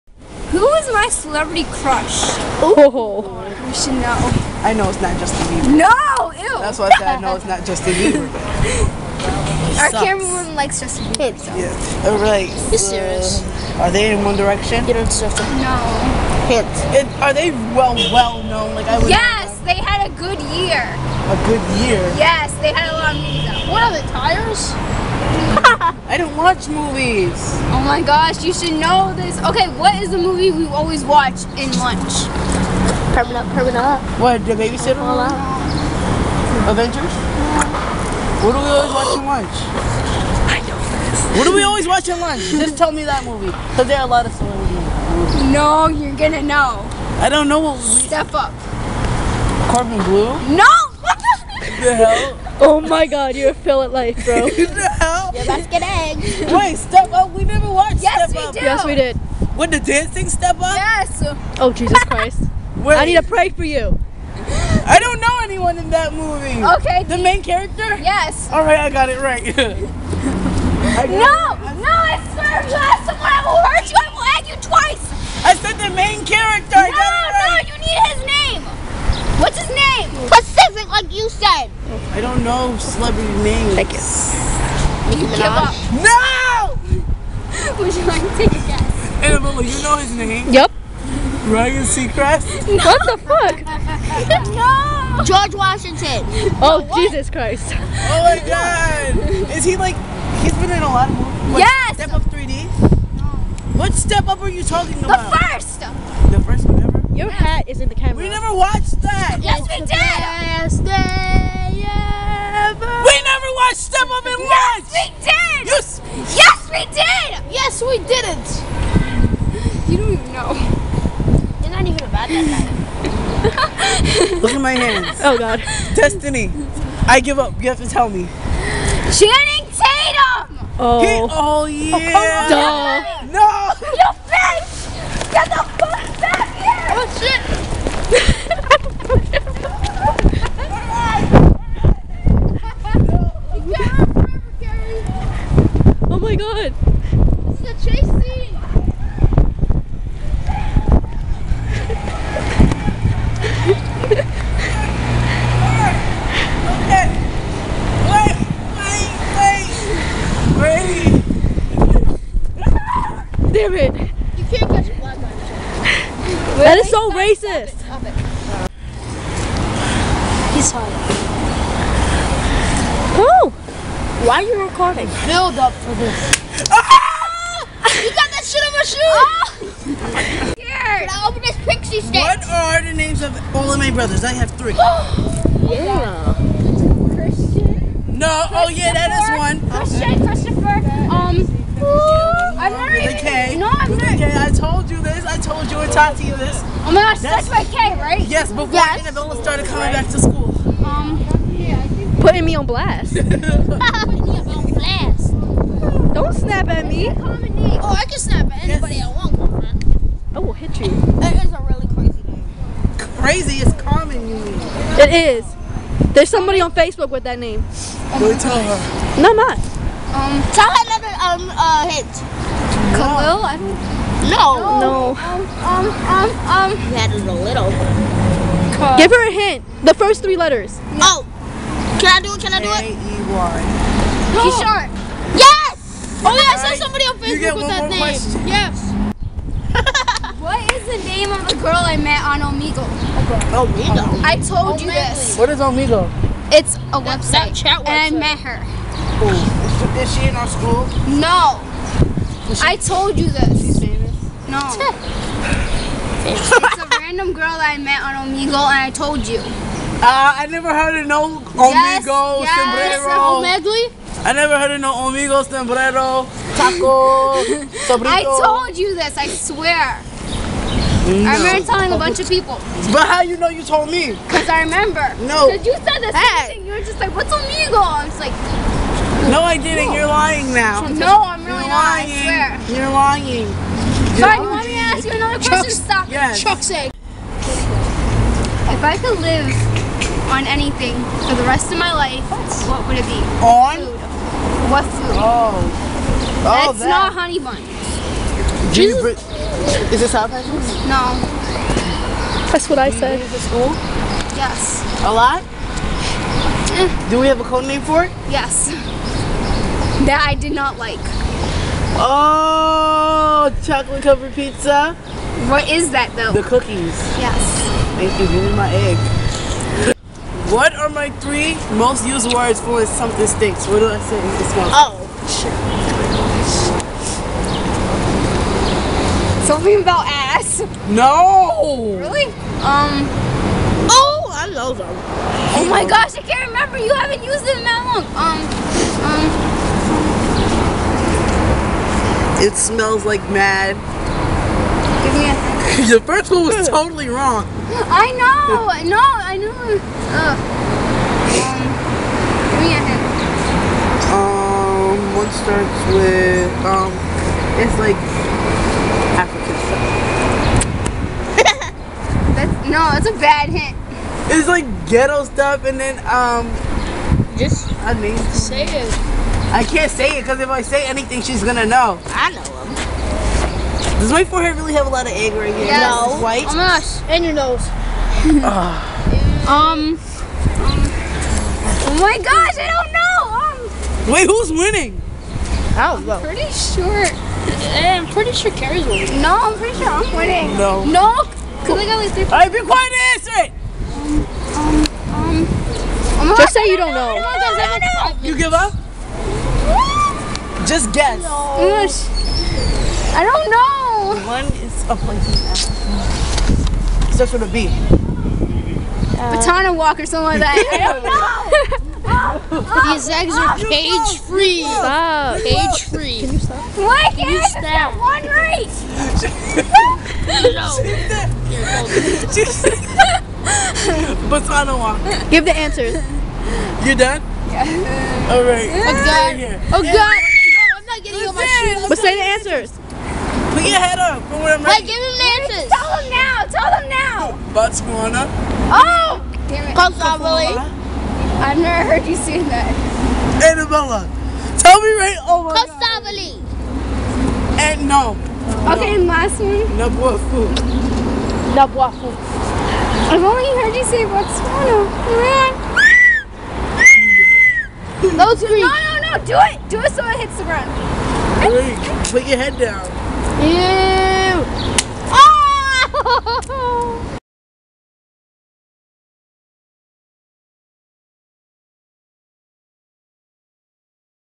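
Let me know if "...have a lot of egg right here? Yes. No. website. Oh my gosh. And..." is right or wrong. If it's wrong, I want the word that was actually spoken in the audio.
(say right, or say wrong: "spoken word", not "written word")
wrong: "white", not "website".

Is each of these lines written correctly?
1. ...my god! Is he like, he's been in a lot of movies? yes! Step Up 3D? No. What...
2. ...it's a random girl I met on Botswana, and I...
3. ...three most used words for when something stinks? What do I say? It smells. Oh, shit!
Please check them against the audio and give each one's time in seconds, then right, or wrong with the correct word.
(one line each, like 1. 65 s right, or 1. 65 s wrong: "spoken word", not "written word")
1. 98 s right
2. 256 s wrong: "Omigo", not "Botswana"
3. 321 s right.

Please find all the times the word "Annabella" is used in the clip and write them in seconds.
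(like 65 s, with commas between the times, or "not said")
89 s, 199 s, 443 s.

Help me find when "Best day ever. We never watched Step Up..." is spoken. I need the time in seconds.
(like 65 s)
109 s.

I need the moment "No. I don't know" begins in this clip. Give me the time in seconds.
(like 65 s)
401 s.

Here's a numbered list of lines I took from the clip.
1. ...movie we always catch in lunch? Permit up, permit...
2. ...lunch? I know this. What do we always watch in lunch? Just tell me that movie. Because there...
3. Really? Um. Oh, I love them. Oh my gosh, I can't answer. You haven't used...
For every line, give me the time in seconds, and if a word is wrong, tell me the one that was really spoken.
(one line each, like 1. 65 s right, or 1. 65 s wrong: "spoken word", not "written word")
1. 30 s wrong: "watch", not "catch"
2. 39 s right
3. 331 s wrong: "remember", not "answer".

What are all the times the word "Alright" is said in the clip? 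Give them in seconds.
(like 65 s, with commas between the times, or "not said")
12 s, 392 s.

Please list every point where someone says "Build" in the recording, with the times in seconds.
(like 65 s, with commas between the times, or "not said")
175 s.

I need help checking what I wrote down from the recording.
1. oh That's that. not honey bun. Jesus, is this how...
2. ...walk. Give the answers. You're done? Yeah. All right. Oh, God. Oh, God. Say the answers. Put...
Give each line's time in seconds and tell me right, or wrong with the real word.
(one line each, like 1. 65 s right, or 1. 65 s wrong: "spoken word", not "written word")
1. 296 s right
2. 424 s right.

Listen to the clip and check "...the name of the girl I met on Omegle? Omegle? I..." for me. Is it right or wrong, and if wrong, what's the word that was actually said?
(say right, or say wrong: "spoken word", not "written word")
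right.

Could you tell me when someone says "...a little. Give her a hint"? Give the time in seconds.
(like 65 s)
227 s.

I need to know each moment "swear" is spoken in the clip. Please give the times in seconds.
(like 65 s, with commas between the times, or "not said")
72 s, 269 s, 282 s.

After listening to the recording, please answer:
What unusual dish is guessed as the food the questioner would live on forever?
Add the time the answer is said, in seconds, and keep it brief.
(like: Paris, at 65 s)
chocolate covered pizza, at 313 s.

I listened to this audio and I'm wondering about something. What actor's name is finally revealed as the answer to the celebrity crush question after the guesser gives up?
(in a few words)
Channing Tatum.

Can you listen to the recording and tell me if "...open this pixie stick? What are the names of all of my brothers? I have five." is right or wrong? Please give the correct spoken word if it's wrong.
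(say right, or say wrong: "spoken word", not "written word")
wrong: "three", not "five".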